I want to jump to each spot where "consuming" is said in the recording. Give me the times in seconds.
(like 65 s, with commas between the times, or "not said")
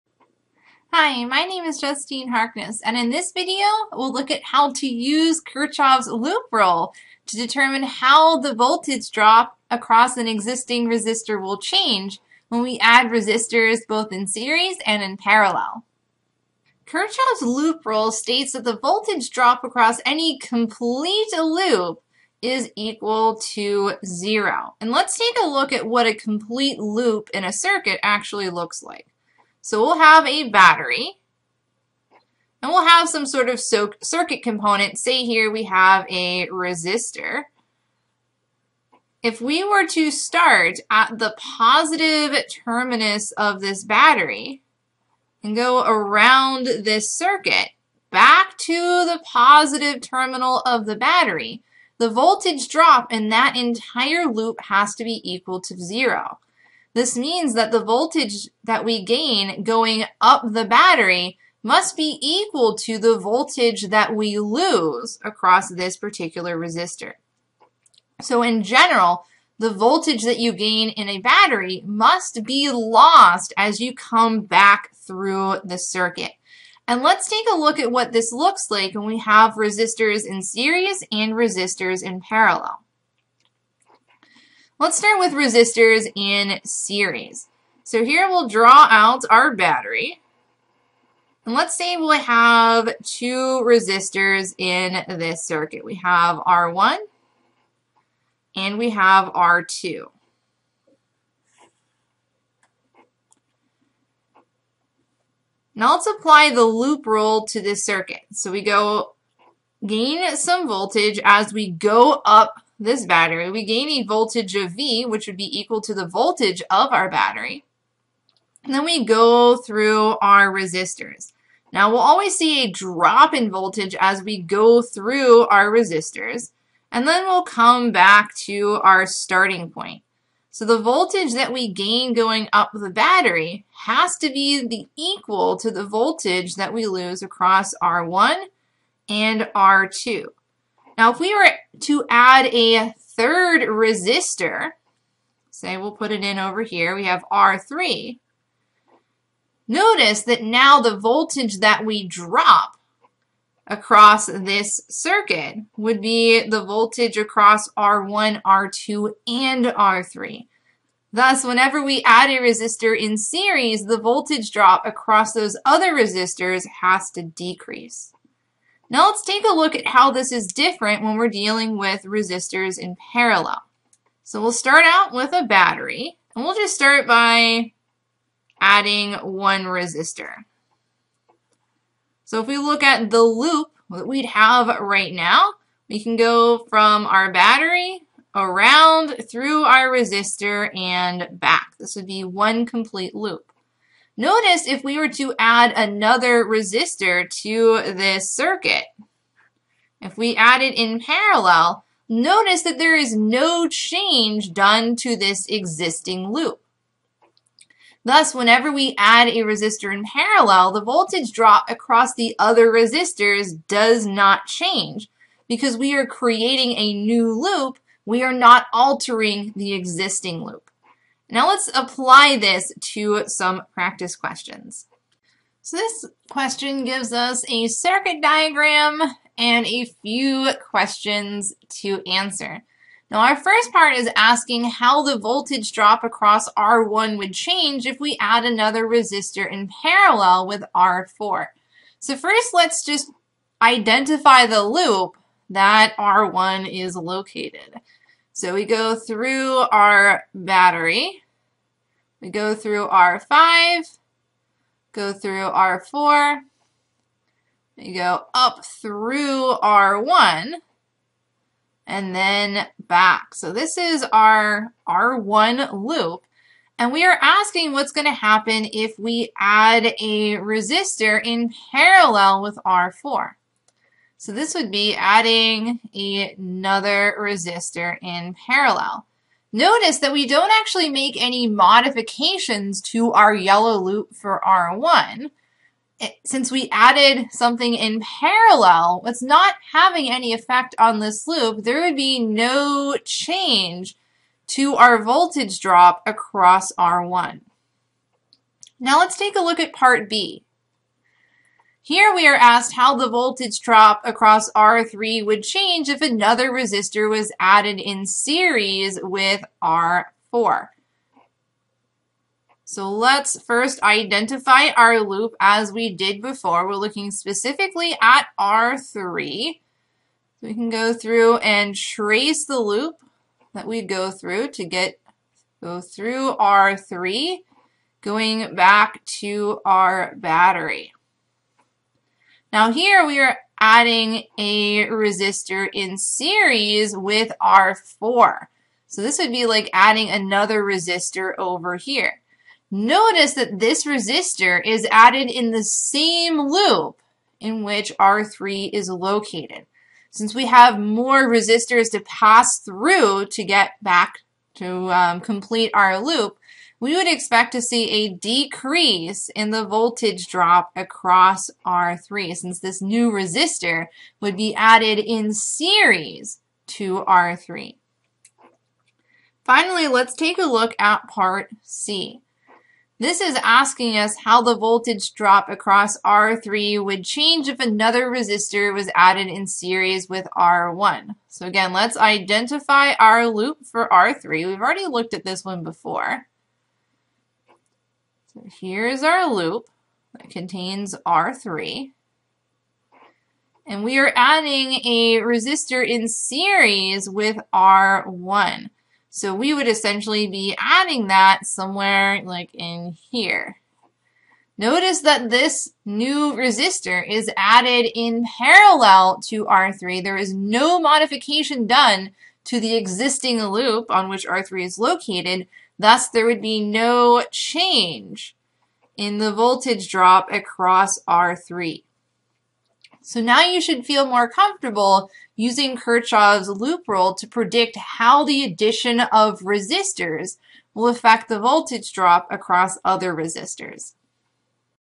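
not said.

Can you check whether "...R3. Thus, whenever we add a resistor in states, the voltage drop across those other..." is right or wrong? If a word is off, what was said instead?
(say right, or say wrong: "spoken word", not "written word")
wrong: "series", not "states".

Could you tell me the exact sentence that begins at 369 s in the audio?
Finally, let's take a look at part C.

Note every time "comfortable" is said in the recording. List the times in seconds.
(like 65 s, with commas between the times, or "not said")
424 s.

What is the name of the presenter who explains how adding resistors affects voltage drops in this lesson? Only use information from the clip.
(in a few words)
Justine Harkness.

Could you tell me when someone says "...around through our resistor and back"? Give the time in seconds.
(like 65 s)
188 s.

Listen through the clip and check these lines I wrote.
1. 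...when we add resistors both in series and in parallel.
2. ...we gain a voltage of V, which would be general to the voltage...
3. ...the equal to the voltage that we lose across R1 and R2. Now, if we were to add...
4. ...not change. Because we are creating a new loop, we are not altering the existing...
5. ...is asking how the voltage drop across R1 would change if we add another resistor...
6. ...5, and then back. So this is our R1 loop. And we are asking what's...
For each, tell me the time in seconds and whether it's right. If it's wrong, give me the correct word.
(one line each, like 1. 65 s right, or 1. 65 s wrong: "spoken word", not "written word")
1. 12 s right
2. 113 s wrong: "equal", not "general"
3. 134 s right
4. 214 s right
5. 233 s right
6. 260 s wrong: "1", not "5".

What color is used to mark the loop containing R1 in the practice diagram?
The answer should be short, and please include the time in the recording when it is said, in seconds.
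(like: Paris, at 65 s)
yellow, at 283 s.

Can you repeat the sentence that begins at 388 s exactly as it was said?
So here's our loop that contains R3.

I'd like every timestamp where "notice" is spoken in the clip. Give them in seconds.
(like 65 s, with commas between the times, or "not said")
149 s, 194 s, 202 s, 279 s, 342 s, 404 s.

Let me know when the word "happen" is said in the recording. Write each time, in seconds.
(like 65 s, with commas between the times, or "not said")
268 s.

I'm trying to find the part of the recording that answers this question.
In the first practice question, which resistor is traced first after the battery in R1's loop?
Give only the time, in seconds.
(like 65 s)
252 s.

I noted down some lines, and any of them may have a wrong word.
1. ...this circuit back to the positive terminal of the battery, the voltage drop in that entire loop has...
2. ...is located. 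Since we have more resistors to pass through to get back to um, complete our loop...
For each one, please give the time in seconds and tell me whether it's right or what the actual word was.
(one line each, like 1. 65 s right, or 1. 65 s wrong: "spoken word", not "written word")
1. 46 s right
2. 348 s right.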